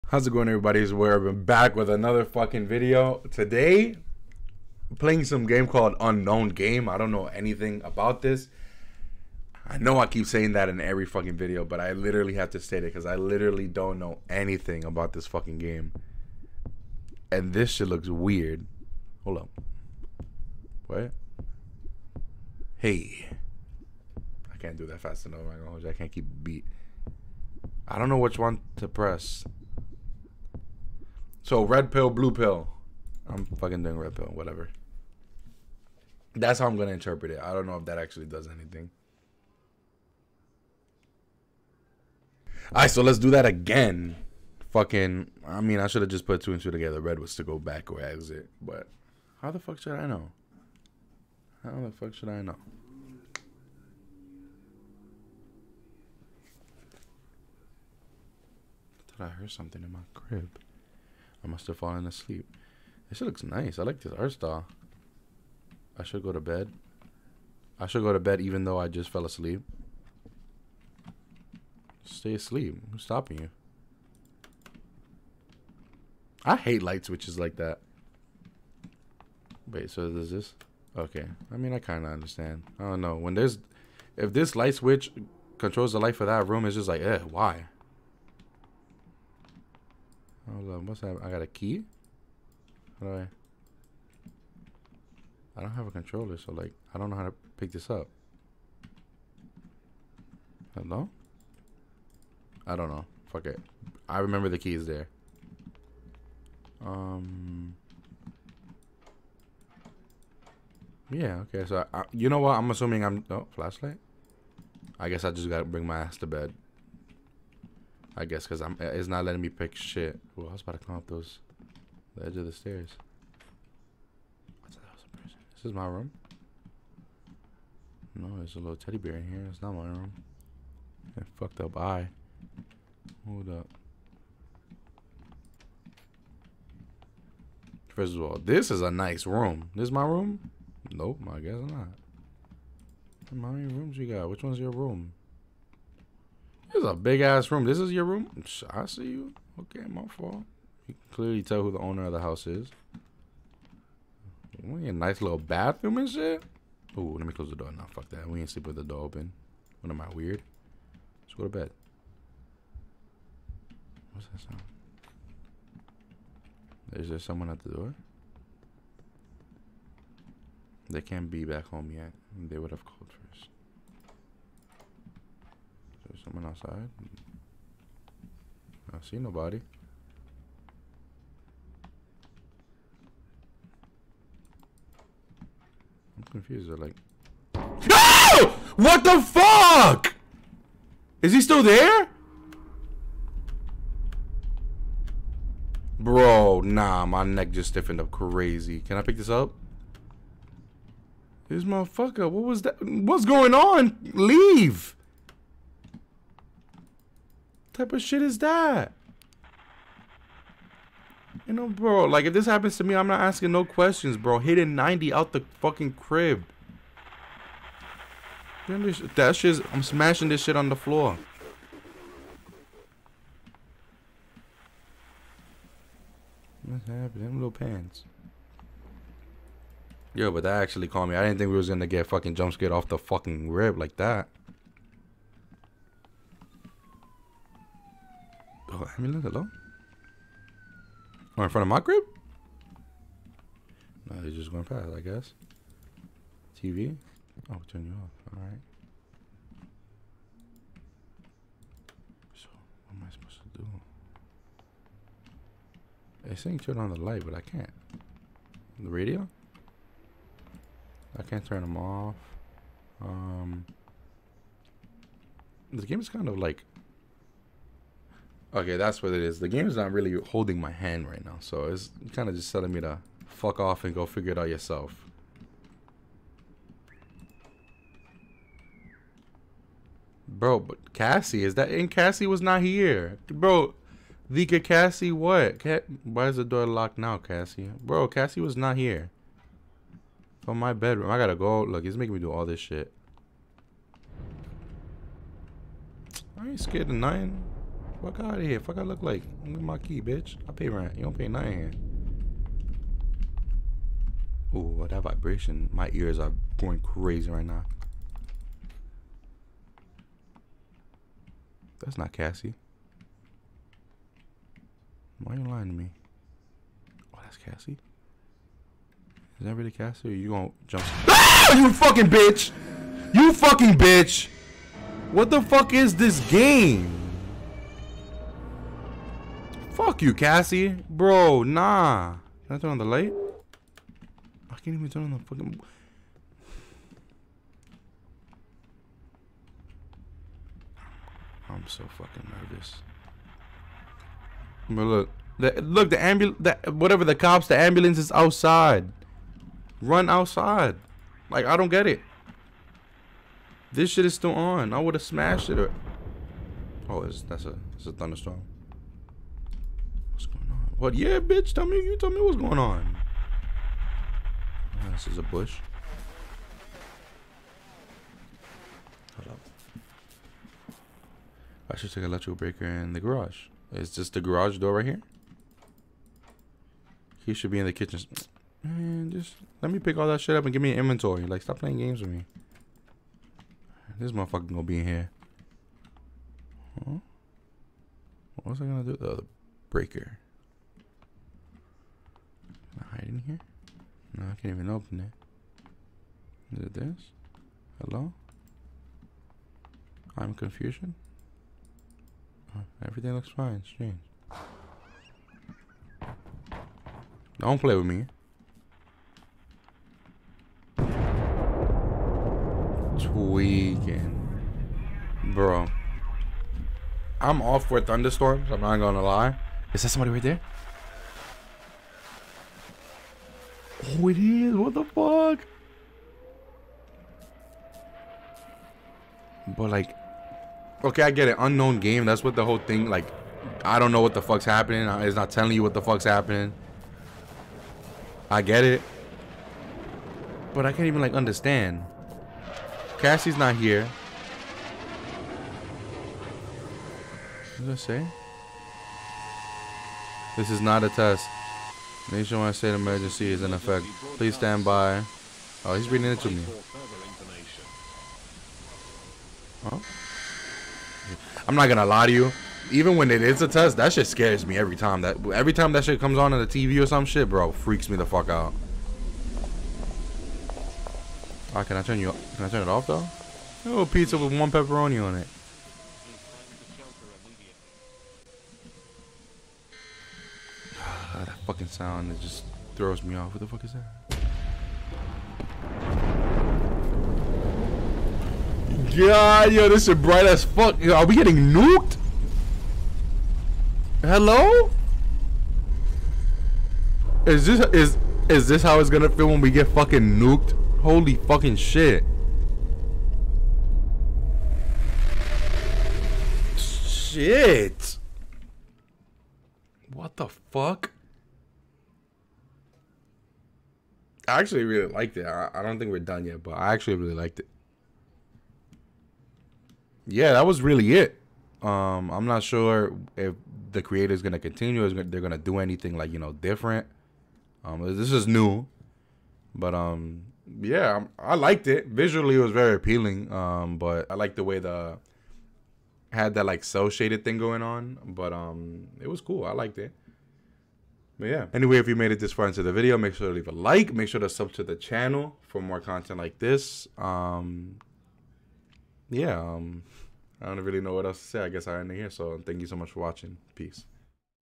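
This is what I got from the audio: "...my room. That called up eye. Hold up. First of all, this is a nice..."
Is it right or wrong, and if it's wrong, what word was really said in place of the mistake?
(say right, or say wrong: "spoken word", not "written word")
wrong: "fucked", not "called".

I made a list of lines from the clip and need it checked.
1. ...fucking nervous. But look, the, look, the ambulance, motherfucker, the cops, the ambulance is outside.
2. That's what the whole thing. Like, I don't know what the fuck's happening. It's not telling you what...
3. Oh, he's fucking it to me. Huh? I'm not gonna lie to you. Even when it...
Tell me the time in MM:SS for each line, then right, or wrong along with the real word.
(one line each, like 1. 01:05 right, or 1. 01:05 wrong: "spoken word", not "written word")
1. 05:41 wrong: "whatever", not "motherfucker"
2. 07:12 right
3. 07:35 wrong: "reading", not "fucking".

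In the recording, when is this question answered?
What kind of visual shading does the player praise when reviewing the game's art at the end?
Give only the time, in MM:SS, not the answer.
08:56.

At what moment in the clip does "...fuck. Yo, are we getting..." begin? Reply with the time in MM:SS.
08:10.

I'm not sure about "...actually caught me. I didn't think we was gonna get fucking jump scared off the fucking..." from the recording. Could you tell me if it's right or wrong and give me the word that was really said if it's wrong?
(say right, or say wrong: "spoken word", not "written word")
right.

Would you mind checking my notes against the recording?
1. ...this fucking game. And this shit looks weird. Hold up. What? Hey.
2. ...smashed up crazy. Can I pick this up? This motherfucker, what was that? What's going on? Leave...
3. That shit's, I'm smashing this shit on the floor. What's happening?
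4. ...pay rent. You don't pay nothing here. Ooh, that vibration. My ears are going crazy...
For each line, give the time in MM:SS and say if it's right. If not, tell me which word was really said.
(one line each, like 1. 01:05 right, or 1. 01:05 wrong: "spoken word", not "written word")
1. 00:15 right
2. 03:17 wrong: "stiffened", not "smashed"
3. 03:38 right
4. 05:00 right.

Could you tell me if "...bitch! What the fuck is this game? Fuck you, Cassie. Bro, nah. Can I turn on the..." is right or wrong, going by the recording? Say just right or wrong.
right.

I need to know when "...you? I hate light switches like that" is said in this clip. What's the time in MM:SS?
01:13.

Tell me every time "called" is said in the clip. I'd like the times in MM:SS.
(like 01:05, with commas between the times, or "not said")
00:05, 02:52.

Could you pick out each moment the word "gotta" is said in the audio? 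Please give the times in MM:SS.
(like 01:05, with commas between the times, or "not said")
01:55, 04:51.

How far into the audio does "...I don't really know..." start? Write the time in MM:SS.
09:10.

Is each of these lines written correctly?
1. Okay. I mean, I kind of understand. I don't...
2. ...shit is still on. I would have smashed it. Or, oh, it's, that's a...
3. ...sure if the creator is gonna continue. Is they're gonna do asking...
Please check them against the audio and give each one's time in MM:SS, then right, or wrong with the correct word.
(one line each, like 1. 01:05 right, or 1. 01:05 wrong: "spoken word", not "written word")
1. 01:20 right
2. 05:53 right
3. 08:42 wrong: "anything", not "asking".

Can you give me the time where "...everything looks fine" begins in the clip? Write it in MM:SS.
06:42.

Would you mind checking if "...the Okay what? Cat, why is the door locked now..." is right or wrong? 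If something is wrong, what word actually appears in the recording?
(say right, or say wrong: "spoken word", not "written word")
wrong: "Cassie", not "Okay".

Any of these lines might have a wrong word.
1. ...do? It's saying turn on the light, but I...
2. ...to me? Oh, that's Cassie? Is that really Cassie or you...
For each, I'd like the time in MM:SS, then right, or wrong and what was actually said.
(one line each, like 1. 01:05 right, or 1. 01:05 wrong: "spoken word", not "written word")
1. 04:13 right
2. 05:15 right.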